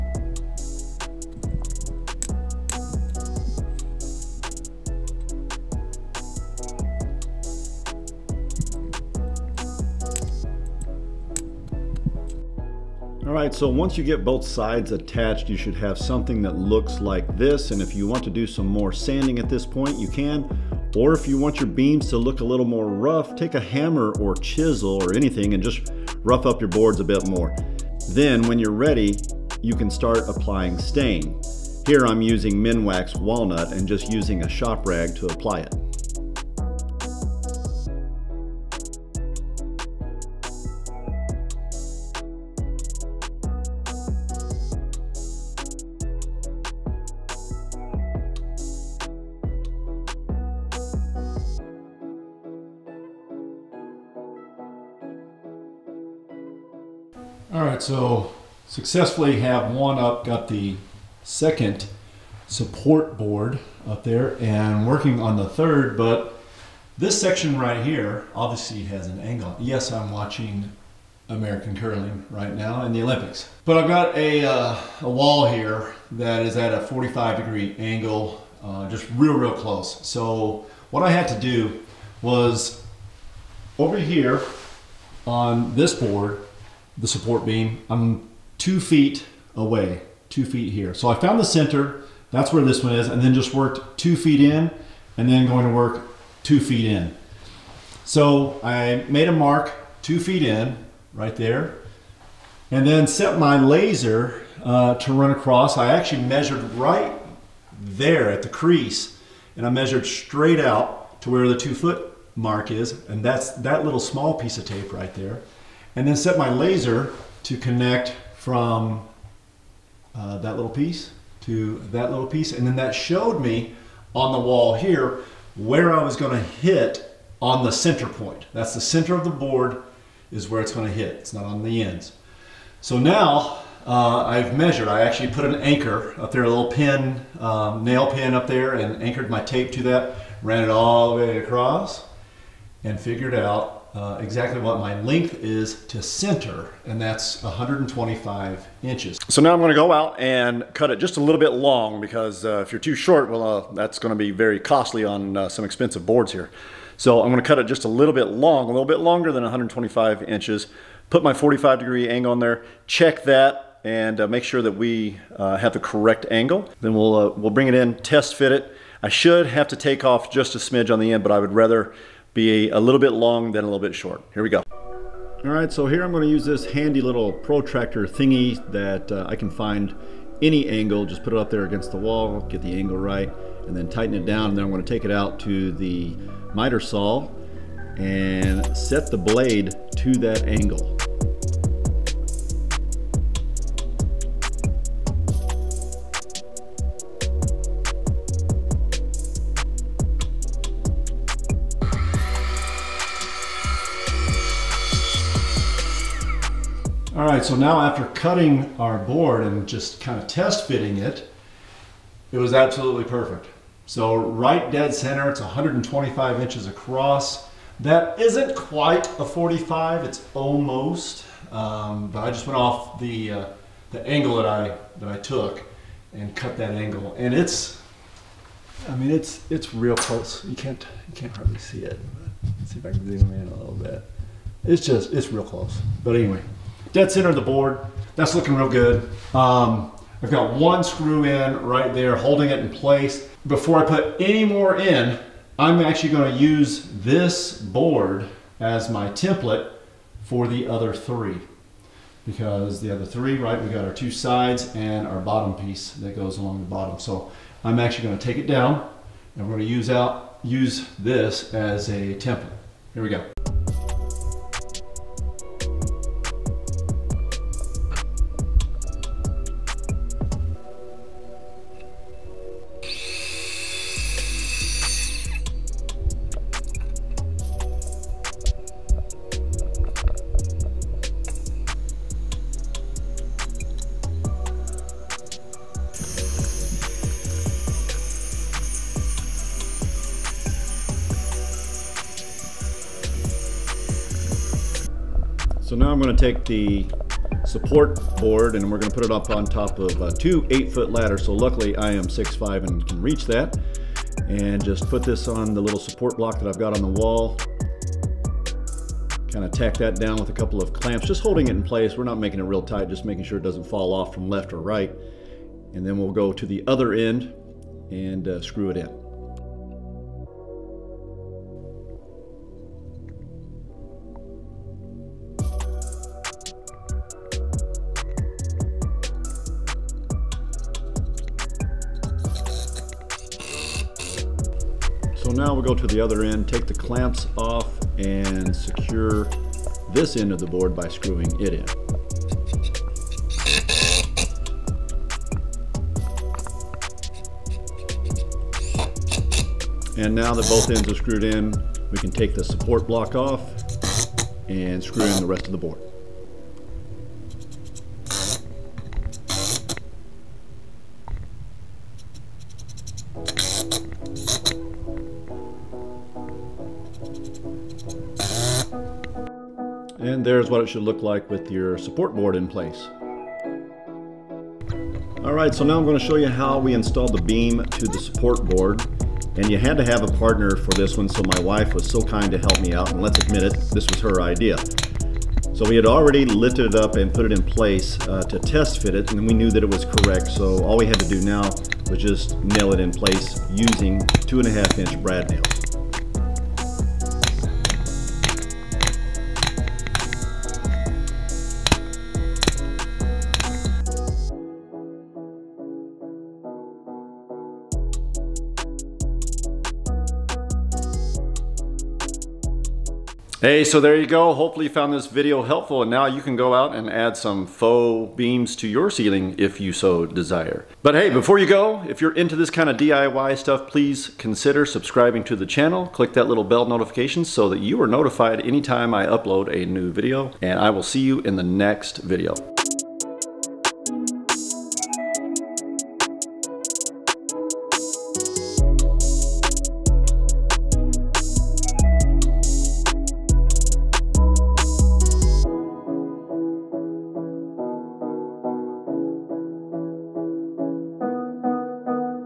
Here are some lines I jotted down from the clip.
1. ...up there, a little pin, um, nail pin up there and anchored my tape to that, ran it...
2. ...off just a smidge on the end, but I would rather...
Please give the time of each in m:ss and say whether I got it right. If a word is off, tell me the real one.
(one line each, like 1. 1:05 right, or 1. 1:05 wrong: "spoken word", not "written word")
1. 2:16 right
2. 2:50 right.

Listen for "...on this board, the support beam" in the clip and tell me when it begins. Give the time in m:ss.
1:25.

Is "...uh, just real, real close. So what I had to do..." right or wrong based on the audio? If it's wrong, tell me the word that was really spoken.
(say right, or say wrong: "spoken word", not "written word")
right.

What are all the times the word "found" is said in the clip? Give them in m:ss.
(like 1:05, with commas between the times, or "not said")
1:31, 6:54.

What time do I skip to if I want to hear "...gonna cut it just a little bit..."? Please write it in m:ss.
2:37.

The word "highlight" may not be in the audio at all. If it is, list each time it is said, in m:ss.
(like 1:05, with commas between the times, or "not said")
not said.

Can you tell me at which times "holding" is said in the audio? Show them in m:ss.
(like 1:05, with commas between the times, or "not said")
4:02, 5:11.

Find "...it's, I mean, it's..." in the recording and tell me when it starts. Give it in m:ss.
3:47.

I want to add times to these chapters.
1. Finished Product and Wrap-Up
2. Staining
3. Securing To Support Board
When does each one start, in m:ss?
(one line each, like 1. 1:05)
1. 6:53
2. 0:13
3. 6:15.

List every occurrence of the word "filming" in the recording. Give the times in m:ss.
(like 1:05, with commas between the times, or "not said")
not said.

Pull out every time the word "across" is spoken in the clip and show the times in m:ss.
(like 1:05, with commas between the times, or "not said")
1:45, 2:21, 3:36.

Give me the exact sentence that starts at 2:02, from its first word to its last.
And then that showed me on the wall here where I was gonna hit on the center point.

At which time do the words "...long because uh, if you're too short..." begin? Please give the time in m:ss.
2:31.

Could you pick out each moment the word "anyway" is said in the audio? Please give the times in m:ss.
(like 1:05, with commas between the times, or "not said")
3:56.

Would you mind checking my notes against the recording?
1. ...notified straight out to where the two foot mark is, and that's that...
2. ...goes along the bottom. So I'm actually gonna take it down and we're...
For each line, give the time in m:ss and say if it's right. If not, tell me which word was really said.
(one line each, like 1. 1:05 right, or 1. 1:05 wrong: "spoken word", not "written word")
1. 1:49 wrong: "measured", not "notified"
2. 4:16 right.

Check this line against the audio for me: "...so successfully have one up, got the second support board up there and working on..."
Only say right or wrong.
right.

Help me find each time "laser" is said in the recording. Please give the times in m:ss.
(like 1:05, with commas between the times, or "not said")
1:43, 1:56.